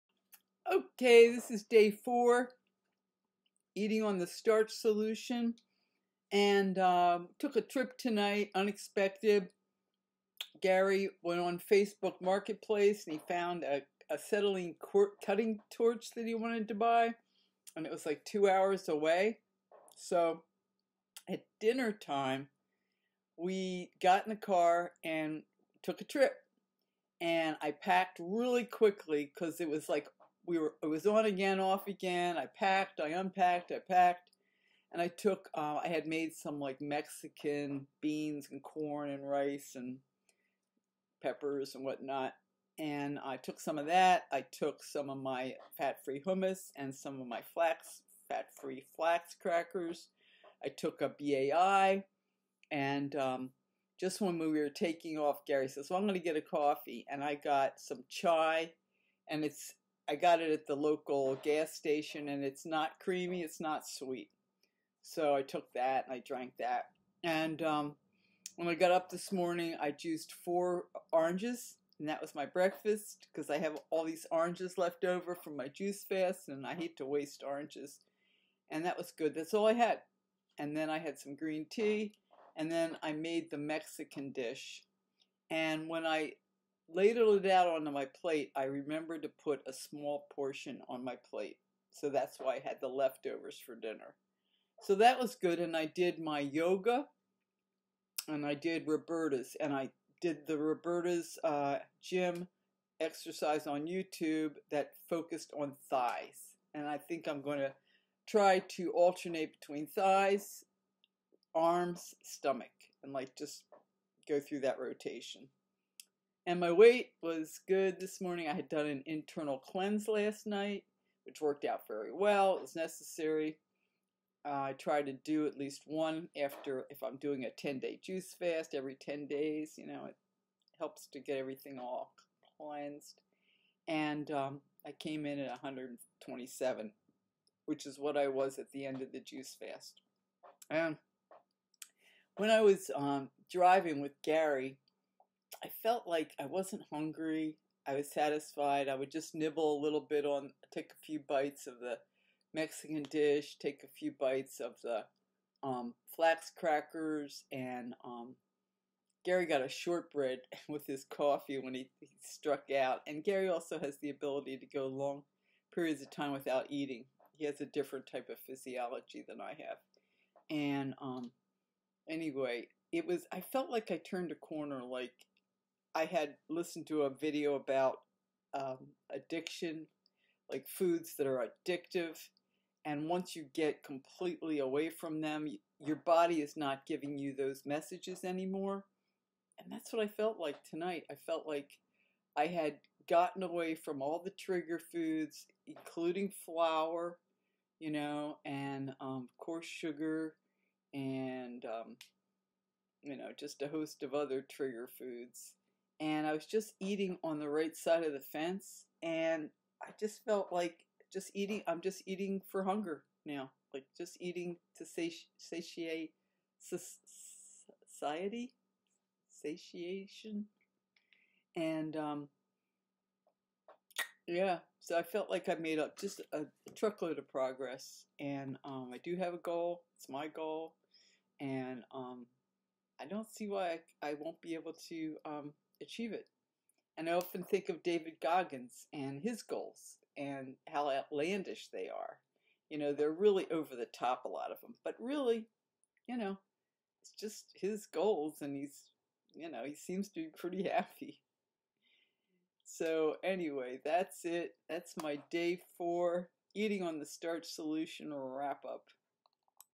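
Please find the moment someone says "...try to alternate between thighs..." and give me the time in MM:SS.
01:48.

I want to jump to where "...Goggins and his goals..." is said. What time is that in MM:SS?
03:58.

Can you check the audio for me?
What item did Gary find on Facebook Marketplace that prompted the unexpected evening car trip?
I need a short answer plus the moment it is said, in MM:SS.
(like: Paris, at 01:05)
Acetylene cutting torch, at 00:14.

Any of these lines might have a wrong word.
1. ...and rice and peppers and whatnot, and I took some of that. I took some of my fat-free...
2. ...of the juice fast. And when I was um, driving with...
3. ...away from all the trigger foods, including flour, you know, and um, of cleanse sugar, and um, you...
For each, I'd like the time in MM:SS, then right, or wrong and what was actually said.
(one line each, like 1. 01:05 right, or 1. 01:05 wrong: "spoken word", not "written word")
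1. 00:39 right
2. 02:19 right
3. 03:13 wrong: "course", not "cleanse".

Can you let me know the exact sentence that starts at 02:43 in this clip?
And Gary also has the ability to go long periods of time without eating.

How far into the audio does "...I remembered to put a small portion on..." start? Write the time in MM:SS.
01:28.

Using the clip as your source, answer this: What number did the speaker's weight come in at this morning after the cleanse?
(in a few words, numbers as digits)
127.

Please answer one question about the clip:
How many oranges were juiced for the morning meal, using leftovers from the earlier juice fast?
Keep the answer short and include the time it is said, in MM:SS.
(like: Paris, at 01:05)
4, at 01:10.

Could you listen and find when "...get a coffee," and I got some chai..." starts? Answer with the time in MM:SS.
00:56.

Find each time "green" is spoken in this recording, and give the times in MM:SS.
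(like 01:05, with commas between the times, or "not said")
01:21.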